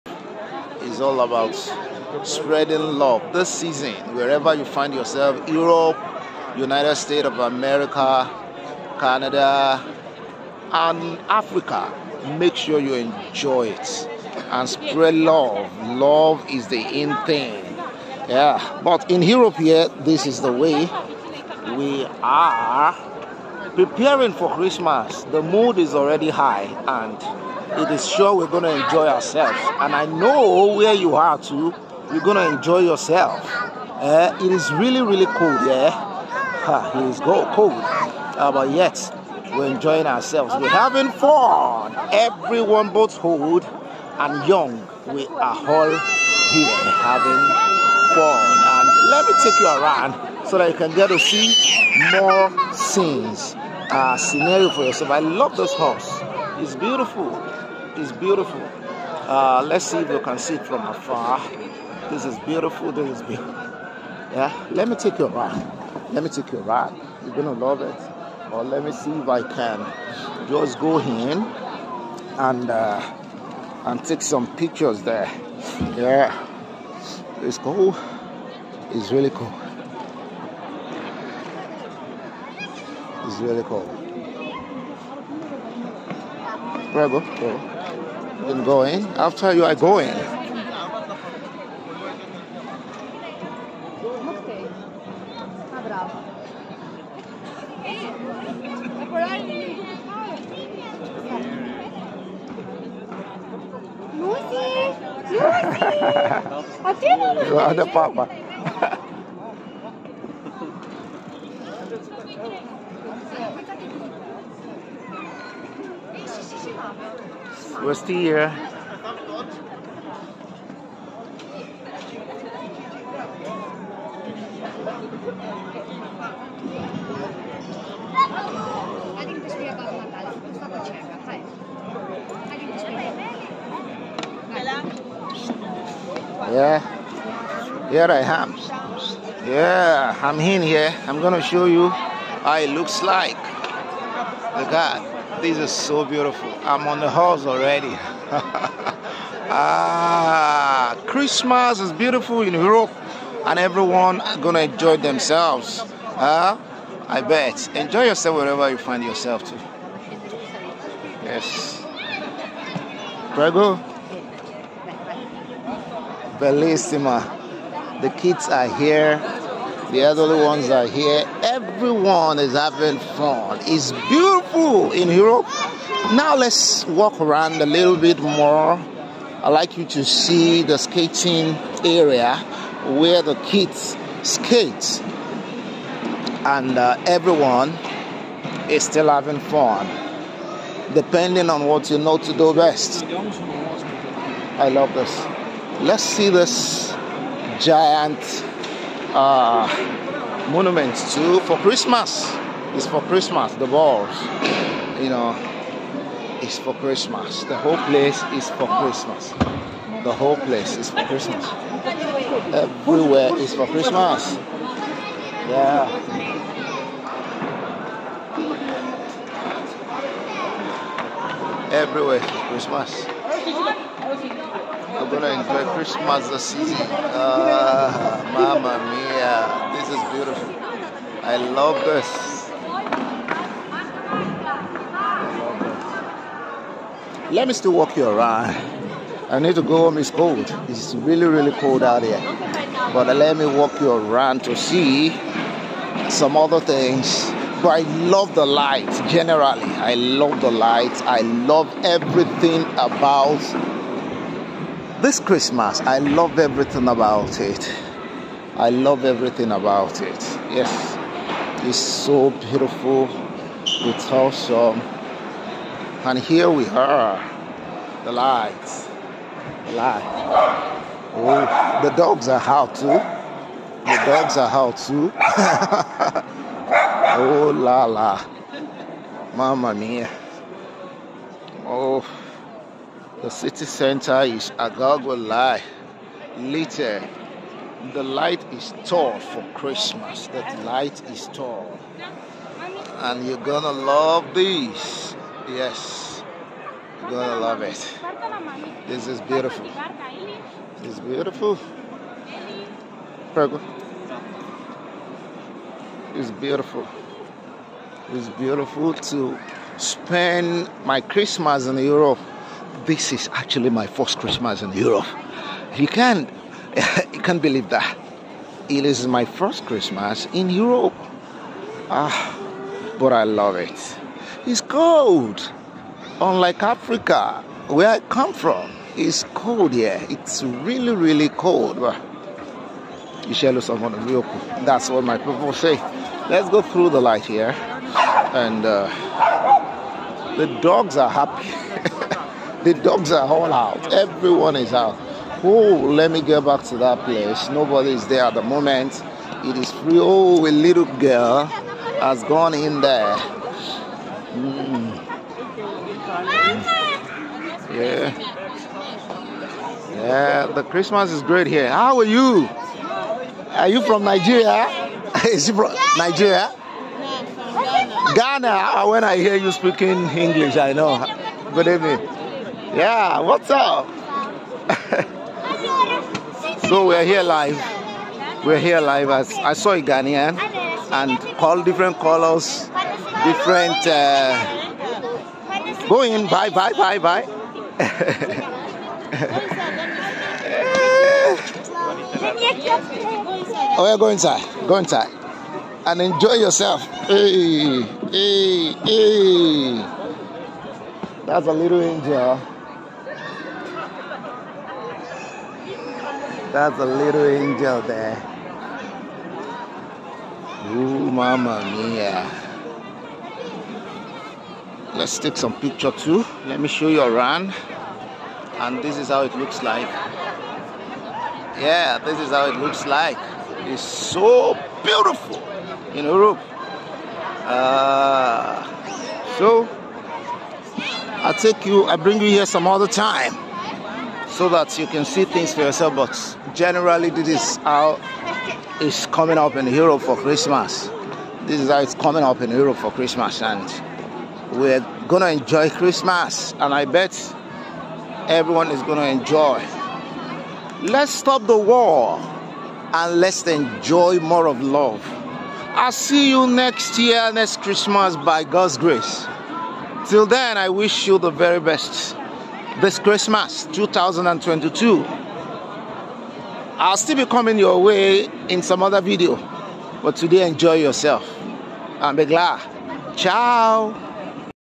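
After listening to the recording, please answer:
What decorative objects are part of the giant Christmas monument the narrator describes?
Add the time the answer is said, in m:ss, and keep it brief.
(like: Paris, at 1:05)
Balls, at 3:23.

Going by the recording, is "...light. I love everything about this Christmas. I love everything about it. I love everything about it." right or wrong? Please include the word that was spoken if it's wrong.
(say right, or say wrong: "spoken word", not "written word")
right.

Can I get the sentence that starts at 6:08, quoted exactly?
Ghana, uh, when I hear you speaking English, I know.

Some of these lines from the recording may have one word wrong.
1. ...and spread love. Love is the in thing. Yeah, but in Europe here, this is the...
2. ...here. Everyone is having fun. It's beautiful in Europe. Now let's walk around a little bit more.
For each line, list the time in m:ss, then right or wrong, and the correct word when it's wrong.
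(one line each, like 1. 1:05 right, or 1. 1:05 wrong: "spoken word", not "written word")
1. 0:14 right
2. 2:50 right.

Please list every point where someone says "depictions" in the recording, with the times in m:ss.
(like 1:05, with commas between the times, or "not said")
not said.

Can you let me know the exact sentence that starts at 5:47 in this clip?
Nobody is there at the moment.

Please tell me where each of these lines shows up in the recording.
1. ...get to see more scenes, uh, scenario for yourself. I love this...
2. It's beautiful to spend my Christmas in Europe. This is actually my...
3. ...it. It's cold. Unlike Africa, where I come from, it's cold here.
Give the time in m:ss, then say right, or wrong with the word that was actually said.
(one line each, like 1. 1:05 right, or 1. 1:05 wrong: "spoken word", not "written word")
1. 0:50 right
2. 5:08 right
3. 5:23 right.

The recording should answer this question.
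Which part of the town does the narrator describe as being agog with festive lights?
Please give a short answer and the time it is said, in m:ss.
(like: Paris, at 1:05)
City center, at 4:43.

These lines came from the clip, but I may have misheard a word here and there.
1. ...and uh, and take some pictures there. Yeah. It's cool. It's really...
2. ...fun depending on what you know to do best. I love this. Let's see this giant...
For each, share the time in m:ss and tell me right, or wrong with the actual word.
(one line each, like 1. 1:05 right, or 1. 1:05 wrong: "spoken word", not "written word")
1. 1:12 right
2. 3:09 right.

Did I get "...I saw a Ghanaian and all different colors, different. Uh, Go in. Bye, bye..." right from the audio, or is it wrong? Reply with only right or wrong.
right.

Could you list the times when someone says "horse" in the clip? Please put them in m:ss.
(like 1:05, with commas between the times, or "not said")
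0:55, 2:27.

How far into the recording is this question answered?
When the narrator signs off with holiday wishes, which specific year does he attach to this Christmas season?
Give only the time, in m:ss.
7:43.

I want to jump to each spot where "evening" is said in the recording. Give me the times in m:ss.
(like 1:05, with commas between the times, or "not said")
6:11.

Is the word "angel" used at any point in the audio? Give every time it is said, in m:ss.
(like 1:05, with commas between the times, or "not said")
6:41, 6:47.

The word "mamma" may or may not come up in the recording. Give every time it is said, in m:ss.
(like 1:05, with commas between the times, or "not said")
3:48, 4:39.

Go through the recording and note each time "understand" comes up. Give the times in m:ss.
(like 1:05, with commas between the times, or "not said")
not said.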